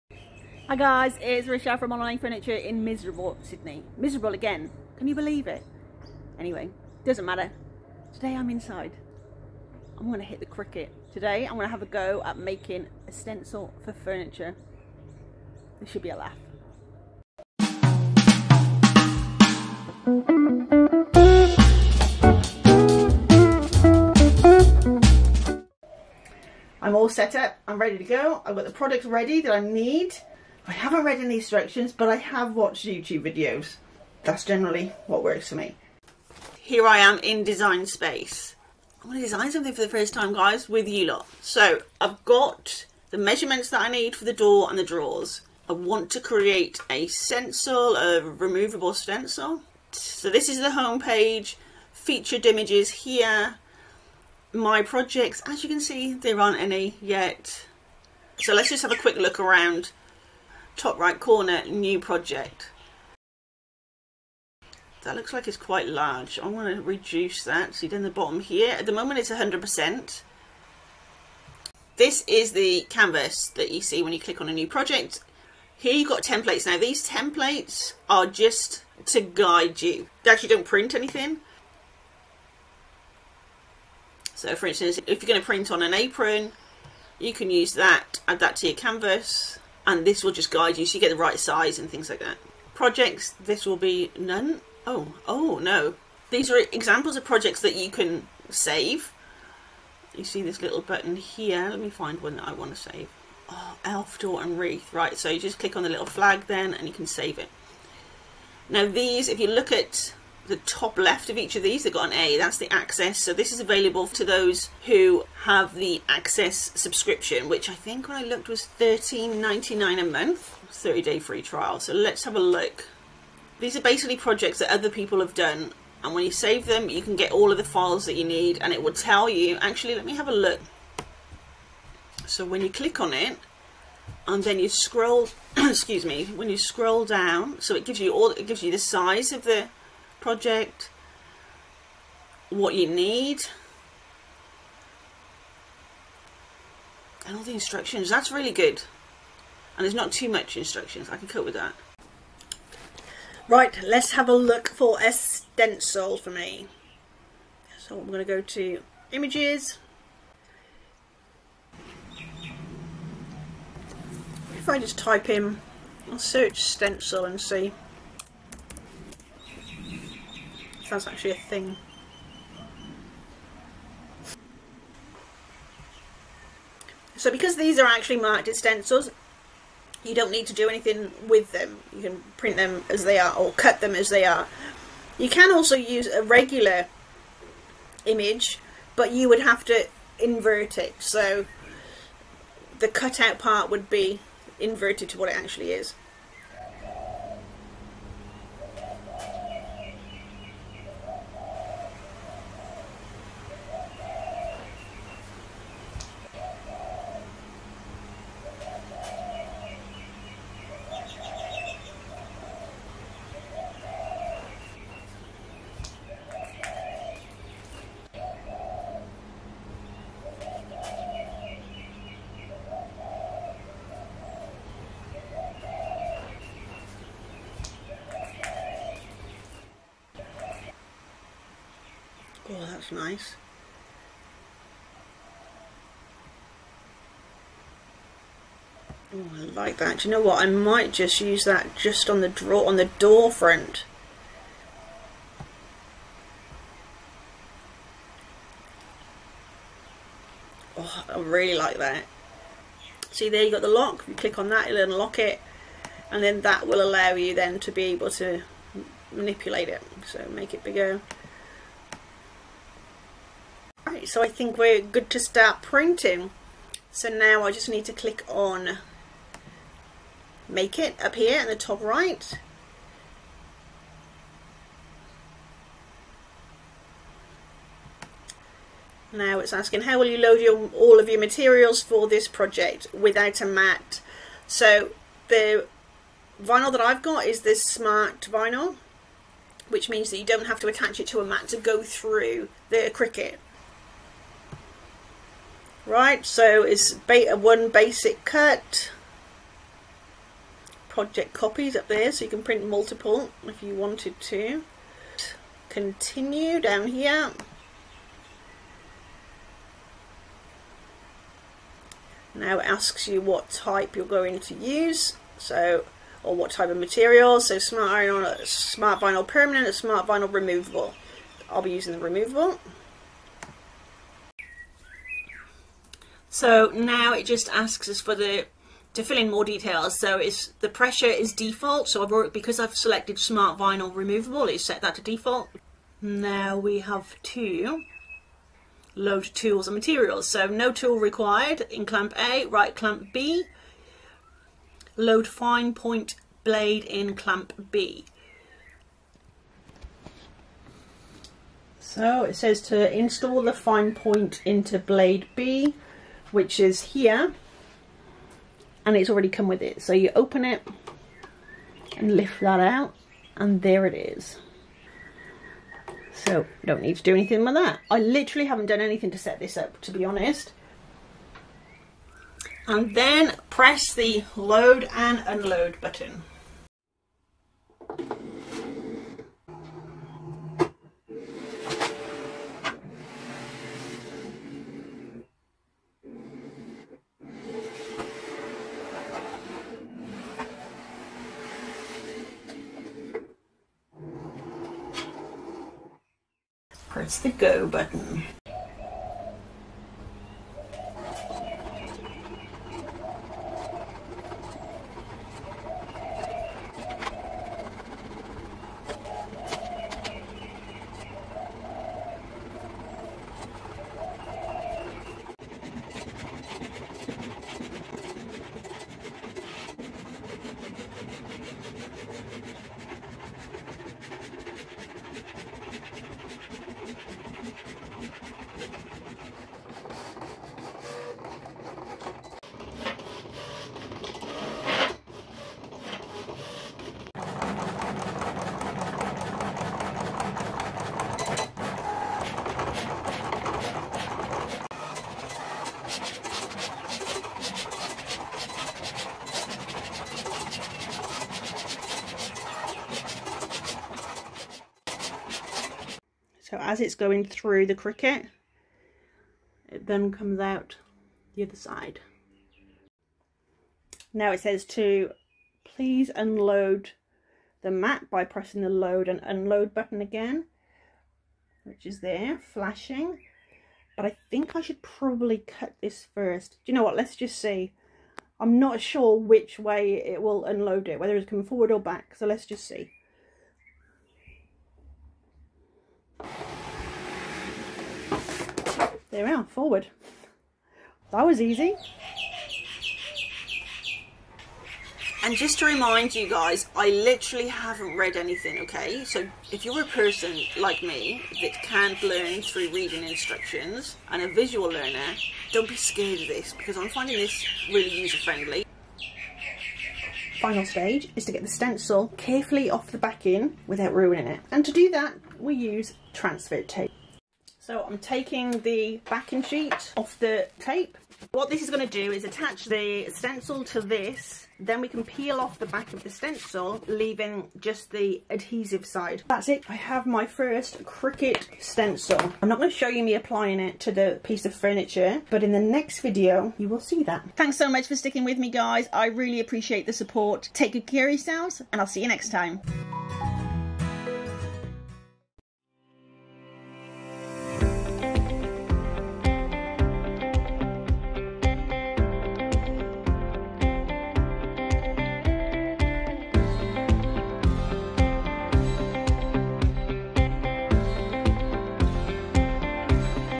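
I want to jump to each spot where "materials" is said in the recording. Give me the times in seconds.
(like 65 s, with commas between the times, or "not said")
281 s, 316 s, 339 s.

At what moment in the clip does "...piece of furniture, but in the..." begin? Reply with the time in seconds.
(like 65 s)
534 s.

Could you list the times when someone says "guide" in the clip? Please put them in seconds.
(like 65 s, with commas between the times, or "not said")
79 s, 90 s.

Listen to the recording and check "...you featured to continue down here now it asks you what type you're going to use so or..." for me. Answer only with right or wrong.
wrong.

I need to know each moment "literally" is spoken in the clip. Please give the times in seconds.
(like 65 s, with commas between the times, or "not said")
367 s, 496 s.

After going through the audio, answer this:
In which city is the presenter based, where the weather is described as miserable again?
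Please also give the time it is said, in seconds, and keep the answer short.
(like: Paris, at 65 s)
Sydney, at 3 s.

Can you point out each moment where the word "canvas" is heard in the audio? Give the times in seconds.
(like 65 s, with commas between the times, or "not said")
72 s, 88 s.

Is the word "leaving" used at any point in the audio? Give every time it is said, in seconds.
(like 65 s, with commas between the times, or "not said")
526 s.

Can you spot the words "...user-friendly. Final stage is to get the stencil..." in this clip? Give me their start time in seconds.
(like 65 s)
507 s.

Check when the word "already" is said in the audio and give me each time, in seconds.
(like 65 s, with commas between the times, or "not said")
332 s, 359 s.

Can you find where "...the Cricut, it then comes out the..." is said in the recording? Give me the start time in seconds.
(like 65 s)
457 s.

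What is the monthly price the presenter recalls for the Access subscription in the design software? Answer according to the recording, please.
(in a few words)
$13.99.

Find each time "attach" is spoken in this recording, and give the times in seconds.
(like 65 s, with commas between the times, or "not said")
290 s, 522 s.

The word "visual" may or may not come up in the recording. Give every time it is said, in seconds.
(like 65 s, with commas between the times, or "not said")
504 s.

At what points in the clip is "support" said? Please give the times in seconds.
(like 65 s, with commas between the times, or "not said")
539 s.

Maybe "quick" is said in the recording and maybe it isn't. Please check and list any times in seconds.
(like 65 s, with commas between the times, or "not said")
58 s.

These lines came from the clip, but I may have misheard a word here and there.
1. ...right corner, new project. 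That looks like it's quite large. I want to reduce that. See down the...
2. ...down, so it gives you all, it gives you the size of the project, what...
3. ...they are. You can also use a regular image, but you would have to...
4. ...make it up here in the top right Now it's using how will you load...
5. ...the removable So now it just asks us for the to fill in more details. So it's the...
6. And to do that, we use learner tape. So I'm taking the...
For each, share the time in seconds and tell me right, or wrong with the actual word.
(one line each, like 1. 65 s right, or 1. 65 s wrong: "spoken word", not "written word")
1. 60 s right
2. 137 s right
3. 184 s right
4. 270 s wrong: "asking", not "using"
5. 321 s right
6. 514 s wrong: "transfer", not "learner".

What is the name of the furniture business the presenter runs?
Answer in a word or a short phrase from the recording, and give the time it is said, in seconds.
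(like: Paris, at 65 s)
Monnow Lane Furniture, at 1 s.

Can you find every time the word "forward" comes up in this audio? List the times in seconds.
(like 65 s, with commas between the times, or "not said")
481 s, 489 s.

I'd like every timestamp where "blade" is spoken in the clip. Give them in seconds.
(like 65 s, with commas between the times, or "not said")
346 s, 354 s.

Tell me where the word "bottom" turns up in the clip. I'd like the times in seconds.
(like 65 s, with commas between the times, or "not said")
68 s.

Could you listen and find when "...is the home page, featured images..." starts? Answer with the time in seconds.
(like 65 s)
50 s.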